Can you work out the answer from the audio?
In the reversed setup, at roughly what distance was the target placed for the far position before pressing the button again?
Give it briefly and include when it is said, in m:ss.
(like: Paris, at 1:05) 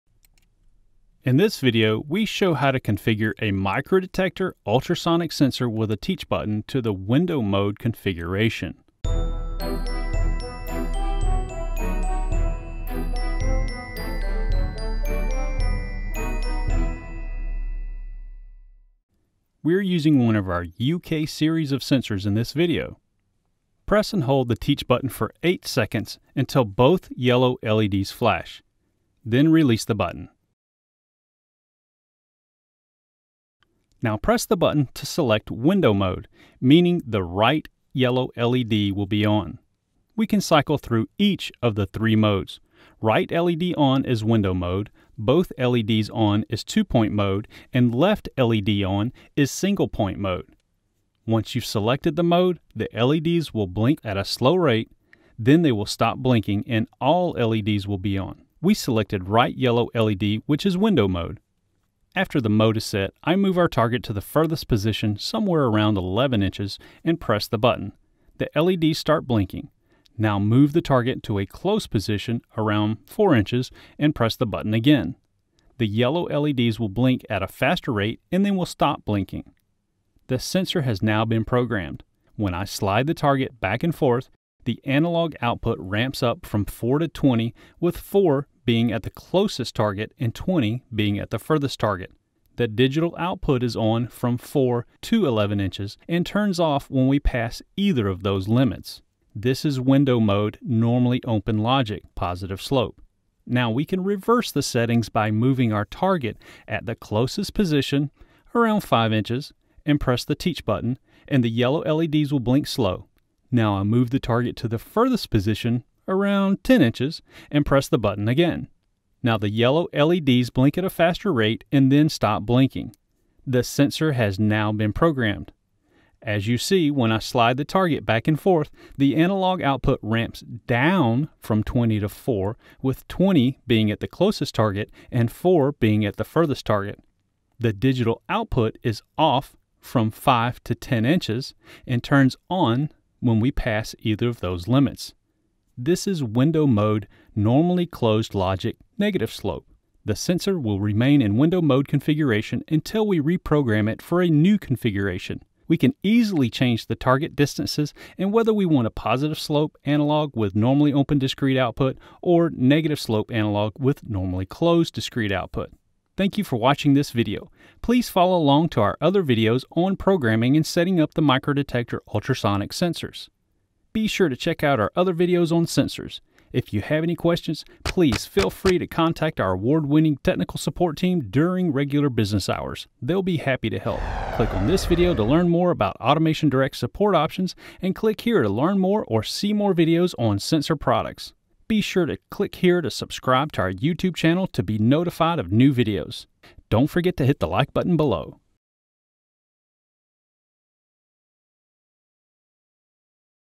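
10 inches, at 1:56.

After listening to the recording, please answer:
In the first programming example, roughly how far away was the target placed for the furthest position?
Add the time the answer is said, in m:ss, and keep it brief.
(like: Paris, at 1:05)
11 inches, at 1:05.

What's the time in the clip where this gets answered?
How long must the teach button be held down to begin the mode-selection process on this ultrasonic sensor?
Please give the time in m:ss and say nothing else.
0:25.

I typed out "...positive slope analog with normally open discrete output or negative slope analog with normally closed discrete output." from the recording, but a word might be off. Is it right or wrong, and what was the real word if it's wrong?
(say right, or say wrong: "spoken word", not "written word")
right.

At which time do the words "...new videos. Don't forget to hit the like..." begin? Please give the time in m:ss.
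3:15.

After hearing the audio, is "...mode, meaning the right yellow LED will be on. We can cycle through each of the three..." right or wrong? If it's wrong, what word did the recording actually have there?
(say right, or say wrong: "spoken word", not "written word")
right.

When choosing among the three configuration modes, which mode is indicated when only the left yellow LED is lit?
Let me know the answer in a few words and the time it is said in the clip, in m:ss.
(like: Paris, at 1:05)
single-point mode, at 0:49.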